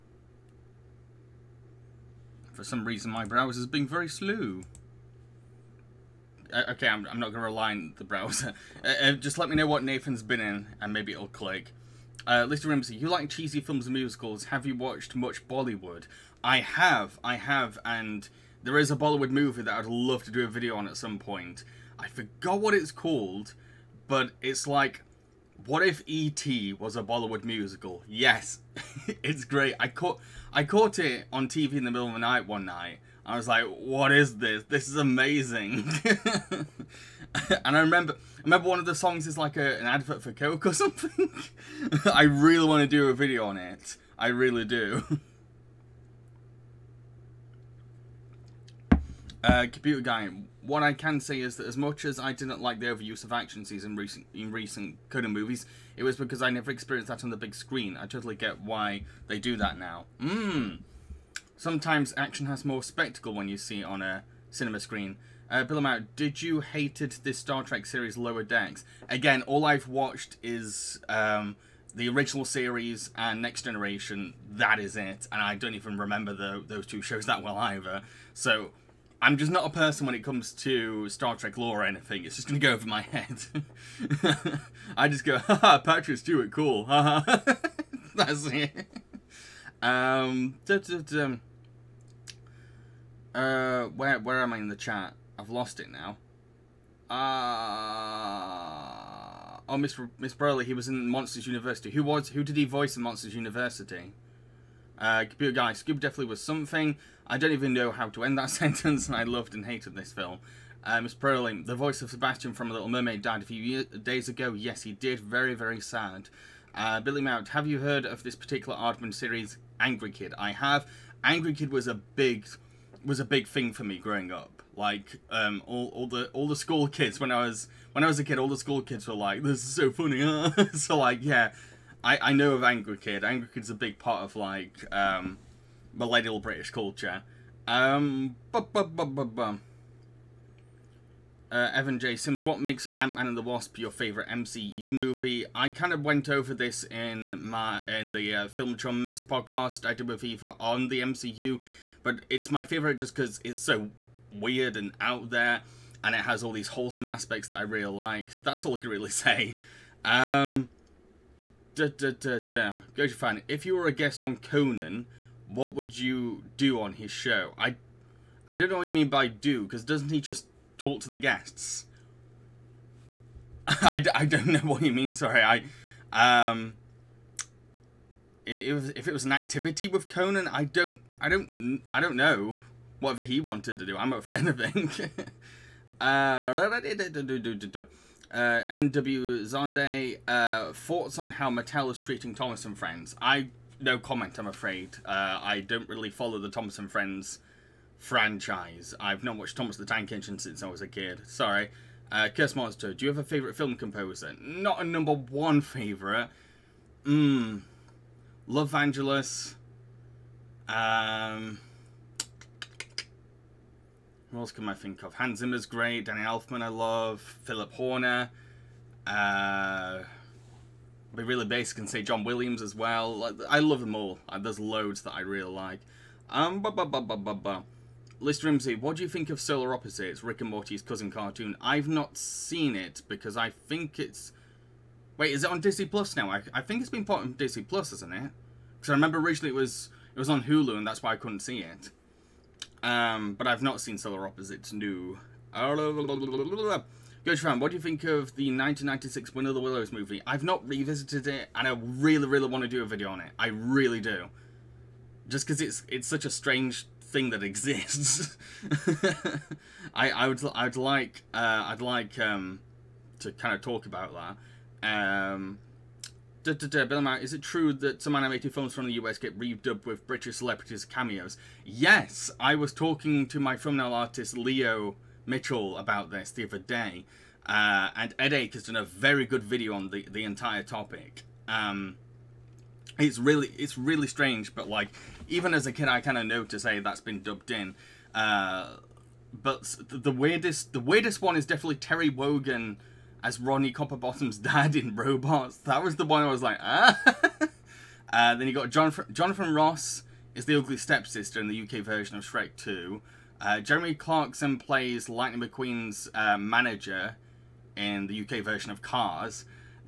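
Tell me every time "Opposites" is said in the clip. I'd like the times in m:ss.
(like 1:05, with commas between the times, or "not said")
3:49, 4:04.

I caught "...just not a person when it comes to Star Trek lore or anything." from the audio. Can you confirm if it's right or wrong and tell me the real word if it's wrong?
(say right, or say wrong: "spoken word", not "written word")
right.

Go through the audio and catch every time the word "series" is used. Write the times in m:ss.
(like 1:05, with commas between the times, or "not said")
1:07, 1:12, 1:59.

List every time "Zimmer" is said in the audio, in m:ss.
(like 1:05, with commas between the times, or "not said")
3:35.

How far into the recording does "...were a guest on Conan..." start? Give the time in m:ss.
2:43.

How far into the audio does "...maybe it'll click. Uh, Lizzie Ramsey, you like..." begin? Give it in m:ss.
0:10.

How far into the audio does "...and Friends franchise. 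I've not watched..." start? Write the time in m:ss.
3:16.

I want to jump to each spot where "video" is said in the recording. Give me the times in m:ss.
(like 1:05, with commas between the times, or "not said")
0:20, 0:43, 4:12, 4:39.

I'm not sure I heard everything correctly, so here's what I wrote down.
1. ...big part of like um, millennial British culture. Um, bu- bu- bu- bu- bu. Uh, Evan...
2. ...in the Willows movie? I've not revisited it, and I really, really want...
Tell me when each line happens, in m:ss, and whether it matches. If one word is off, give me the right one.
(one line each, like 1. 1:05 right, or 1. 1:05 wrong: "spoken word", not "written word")
1. 2:13 right
2. 4:09 right.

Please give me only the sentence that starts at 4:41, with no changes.
Um, it's really it's really strange, but like even as a kid, I kind of noticed, hey, that's been dubbed in.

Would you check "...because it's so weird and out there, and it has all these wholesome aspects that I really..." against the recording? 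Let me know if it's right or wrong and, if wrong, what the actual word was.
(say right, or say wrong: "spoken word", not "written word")
right.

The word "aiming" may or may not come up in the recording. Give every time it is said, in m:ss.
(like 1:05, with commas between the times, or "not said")
not said.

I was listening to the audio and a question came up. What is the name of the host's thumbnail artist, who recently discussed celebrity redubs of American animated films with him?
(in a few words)
Leo Mitchell.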